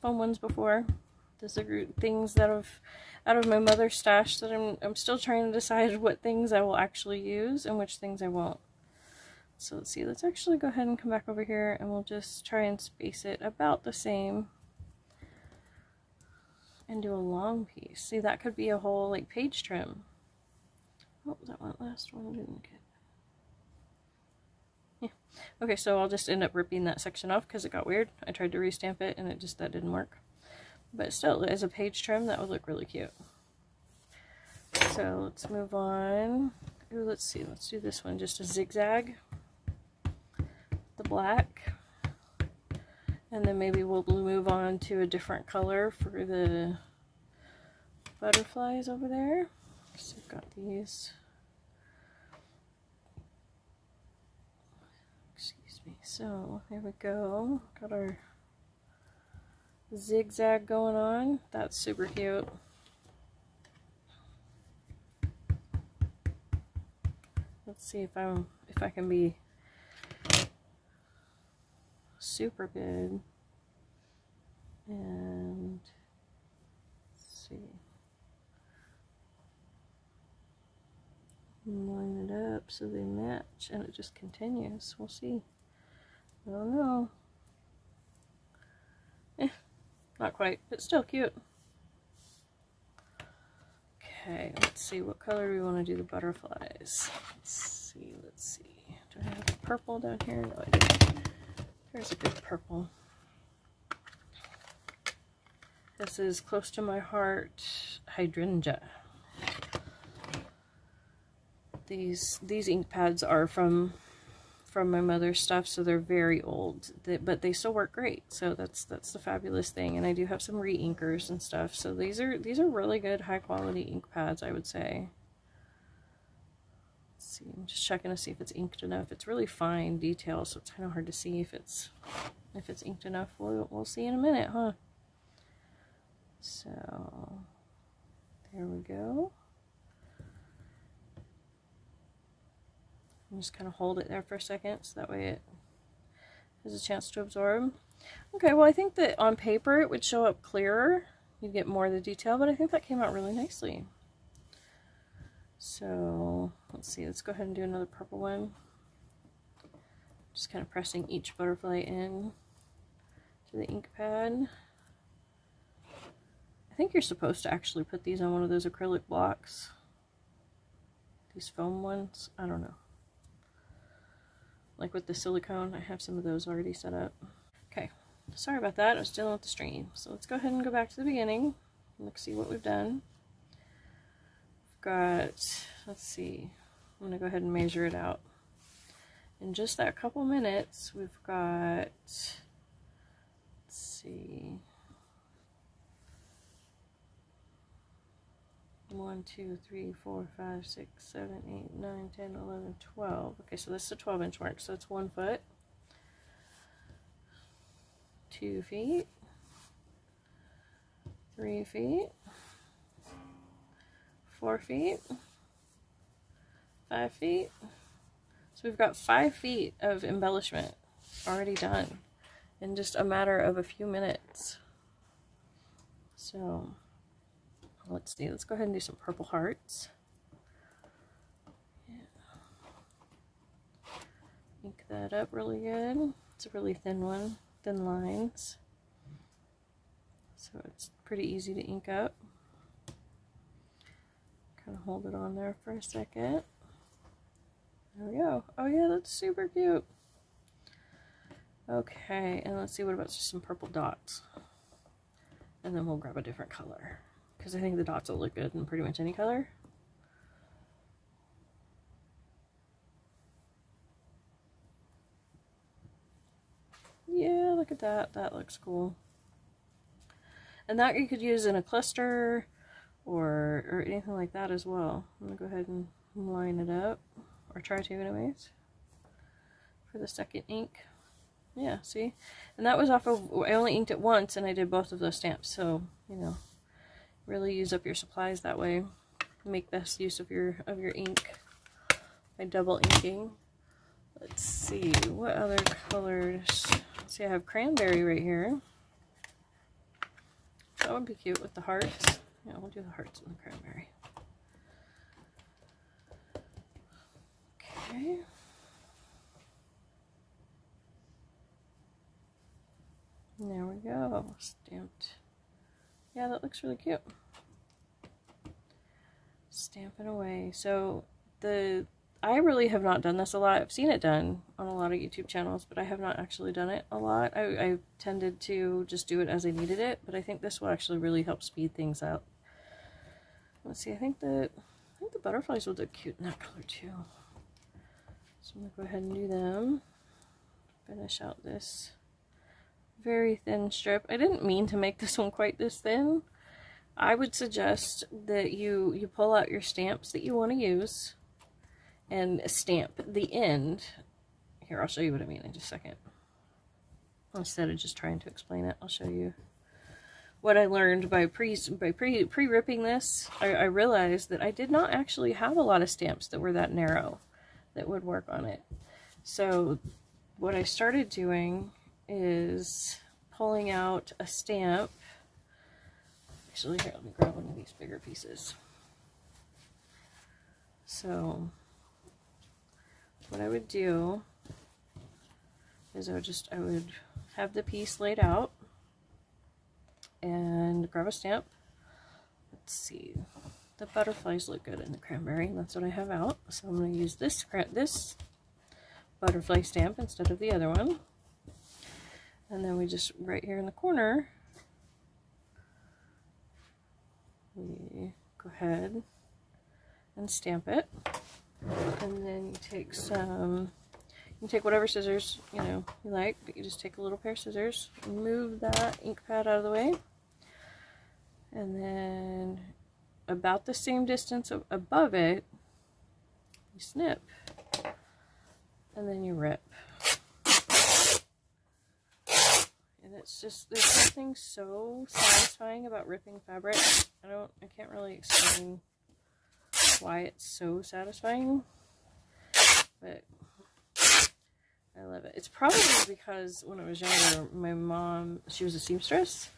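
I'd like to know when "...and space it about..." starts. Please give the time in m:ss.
0:12.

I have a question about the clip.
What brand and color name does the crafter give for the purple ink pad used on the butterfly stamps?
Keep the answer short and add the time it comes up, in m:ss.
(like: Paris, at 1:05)
Close to My Heart Hydrangea, at 1:46.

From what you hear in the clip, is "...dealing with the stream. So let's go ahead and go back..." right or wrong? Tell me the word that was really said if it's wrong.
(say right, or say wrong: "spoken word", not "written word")
right.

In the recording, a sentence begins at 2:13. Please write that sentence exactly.
We'll, we'll see in a minute, huh?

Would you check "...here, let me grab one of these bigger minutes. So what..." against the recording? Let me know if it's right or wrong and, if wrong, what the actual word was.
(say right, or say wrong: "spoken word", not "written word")
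wrong: "pieces", not "minutes".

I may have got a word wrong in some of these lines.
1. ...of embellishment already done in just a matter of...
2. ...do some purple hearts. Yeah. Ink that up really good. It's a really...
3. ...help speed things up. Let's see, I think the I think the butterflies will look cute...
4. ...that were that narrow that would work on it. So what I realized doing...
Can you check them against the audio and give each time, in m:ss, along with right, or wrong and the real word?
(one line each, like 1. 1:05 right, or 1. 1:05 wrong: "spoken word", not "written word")
1. 3:39 right
2. 3:48 right
3. 5:31 right
4. 6:06 wrong: "started", not "realized".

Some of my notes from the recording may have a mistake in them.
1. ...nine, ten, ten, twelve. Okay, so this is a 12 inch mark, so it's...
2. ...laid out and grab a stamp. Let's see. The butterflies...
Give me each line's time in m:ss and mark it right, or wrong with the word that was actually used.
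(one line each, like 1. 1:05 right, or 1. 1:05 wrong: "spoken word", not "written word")
1. 3:21 wrong: "eleven", not "ten"
2. 6:28 right.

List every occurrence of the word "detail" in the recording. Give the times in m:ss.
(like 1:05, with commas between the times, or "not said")
2:09, 2:32.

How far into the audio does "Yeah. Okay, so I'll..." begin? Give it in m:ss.
0:25.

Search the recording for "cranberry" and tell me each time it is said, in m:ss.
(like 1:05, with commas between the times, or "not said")
4:57, 5:03, 6:34.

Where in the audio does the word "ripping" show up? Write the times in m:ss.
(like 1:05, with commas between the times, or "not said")
0:26, 6:02, 7:16.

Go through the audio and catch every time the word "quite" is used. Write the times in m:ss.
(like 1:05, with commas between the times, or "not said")
1:30, 5:45.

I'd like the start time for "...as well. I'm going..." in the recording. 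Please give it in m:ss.
4:34.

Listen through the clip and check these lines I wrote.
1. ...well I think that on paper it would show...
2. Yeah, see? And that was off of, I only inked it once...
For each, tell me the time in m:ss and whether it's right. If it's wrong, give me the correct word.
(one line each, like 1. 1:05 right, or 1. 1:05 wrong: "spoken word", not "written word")
1. 2:28 right
2. 4:41 right.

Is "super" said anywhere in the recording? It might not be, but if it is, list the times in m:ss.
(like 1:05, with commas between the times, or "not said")
1:01, 1:12, 4:09.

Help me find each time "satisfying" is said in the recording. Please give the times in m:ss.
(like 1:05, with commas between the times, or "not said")
7:15, 7:20.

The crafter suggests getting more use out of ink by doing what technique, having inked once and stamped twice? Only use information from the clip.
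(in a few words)
double inking.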